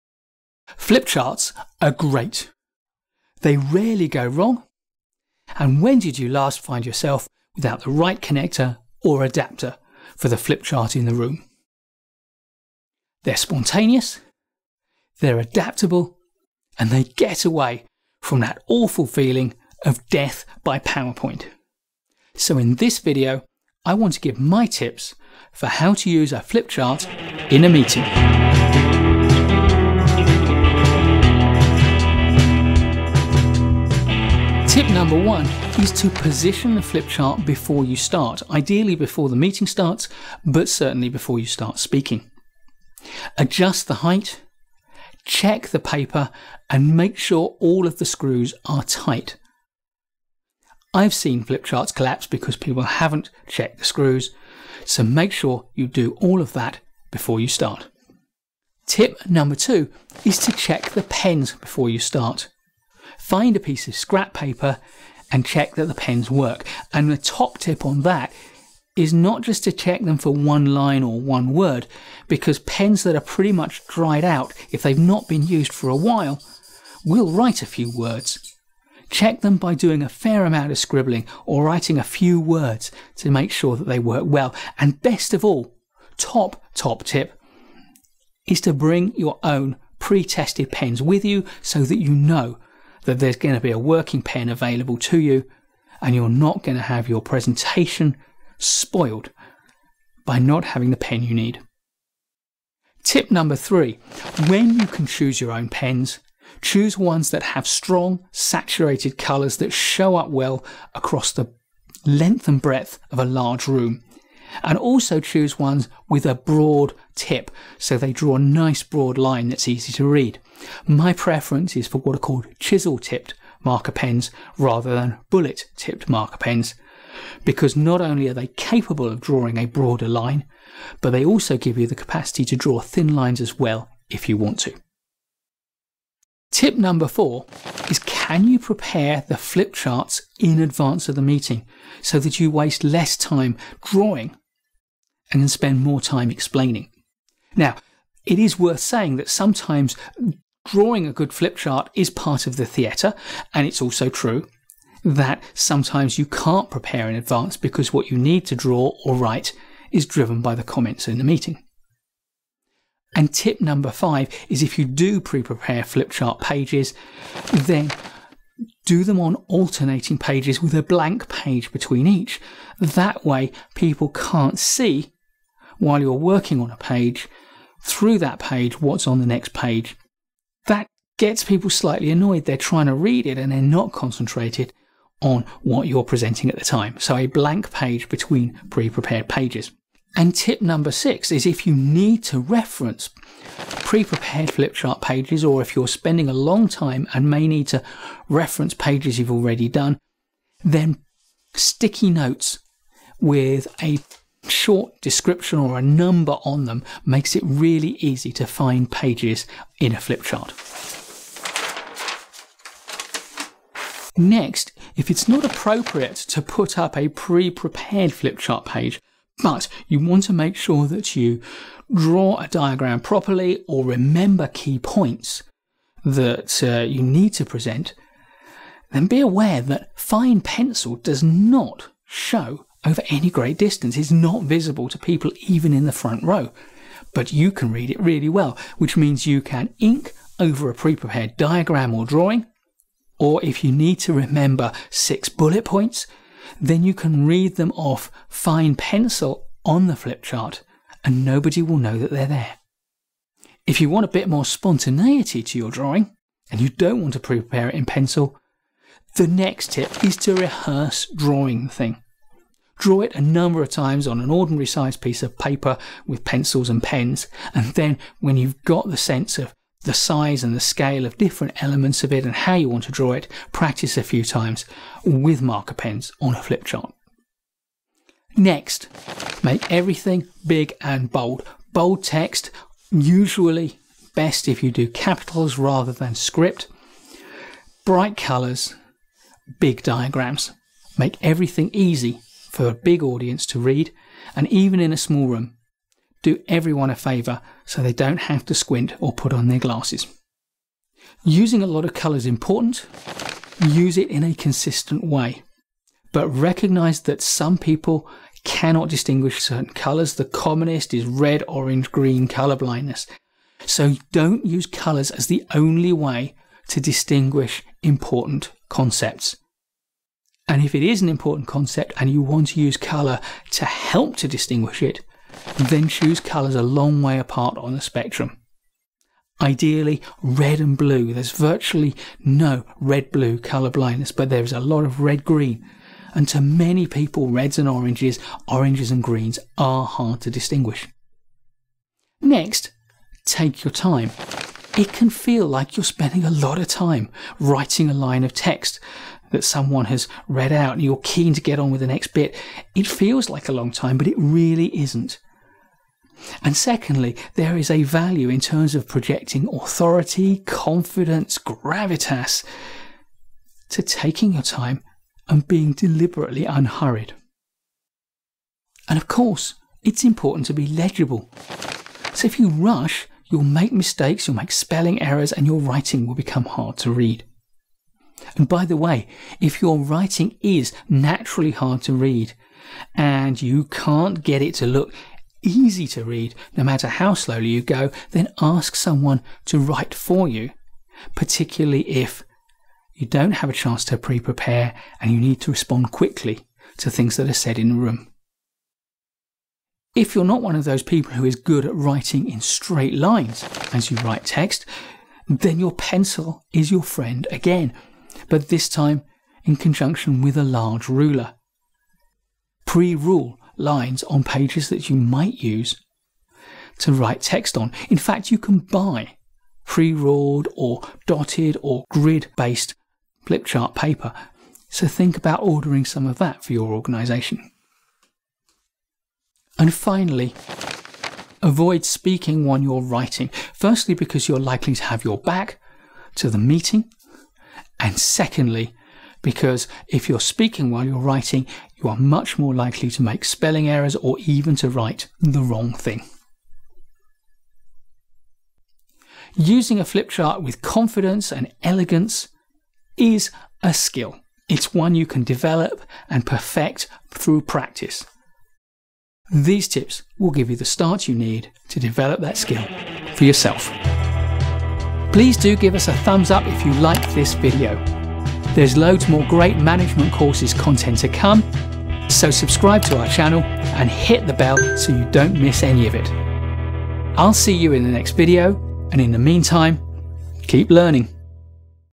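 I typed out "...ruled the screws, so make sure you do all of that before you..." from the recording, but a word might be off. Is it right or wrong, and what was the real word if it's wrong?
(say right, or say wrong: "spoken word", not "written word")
wrong: "checked", not "ruled".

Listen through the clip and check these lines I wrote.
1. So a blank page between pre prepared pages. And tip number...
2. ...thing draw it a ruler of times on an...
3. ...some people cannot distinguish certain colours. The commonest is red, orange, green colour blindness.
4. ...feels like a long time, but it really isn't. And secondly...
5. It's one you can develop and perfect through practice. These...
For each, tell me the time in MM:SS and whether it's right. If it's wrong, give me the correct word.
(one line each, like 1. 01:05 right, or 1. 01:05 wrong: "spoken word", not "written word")
1. 03:06 right
2. 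04:21 wrong: "number", not "ruler"
3. 05:07 right
4. 05:52 right
5. 07:34 right.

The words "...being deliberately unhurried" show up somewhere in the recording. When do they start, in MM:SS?
06:05.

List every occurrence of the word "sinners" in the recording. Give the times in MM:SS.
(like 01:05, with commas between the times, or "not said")
not said.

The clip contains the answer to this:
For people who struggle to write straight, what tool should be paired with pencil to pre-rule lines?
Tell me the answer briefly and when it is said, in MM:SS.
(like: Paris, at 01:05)
a large ruler, at 06:50.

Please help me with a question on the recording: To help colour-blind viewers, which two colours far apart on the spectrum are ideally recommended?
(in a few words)
red and blue.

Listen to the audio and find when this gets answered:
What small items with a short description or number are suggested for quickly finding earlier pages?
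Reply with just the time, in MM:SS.
03:21.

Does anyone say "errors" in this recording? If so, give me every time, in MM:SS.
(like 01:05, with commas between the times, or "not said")
06:15, 07:23.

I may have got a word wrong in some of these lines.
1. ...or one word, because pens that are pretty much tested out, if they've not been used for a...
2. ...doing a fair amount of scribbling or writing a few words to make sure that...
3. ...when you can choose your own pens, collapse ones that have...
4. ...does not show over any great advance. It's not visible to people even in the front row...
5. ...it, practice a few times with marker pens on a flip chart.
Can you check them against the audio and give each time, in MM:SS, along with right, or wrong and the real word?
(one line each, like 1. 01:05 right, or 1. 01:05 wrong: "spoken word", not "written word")
1. 01:11 wrong: "dried", not "tested"
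2. 01:19 right
3. 01:44 wrong: "choose", not "collapse"
4. 03:50 wrong: "distance", not "advance"
5. 04:33 right.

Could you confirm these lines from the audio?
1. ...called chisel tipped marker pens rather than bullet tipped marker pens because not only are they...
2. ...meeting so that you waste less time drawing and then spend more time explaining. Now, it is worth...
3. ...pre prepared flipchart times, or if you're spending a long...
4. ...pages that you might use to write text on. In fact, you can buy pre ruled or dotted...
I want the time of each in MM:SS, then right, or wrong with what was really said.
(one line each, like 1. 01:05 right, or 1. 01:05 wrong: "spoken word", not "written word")
1. 02:02 right
2. 02:21 right
3. 03:13 wrong: "pages", not "times"
4. 06:54 right.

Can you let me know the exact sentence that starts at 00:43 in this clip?
Adjust the height, check the paper, and make sure all of the screws are tight.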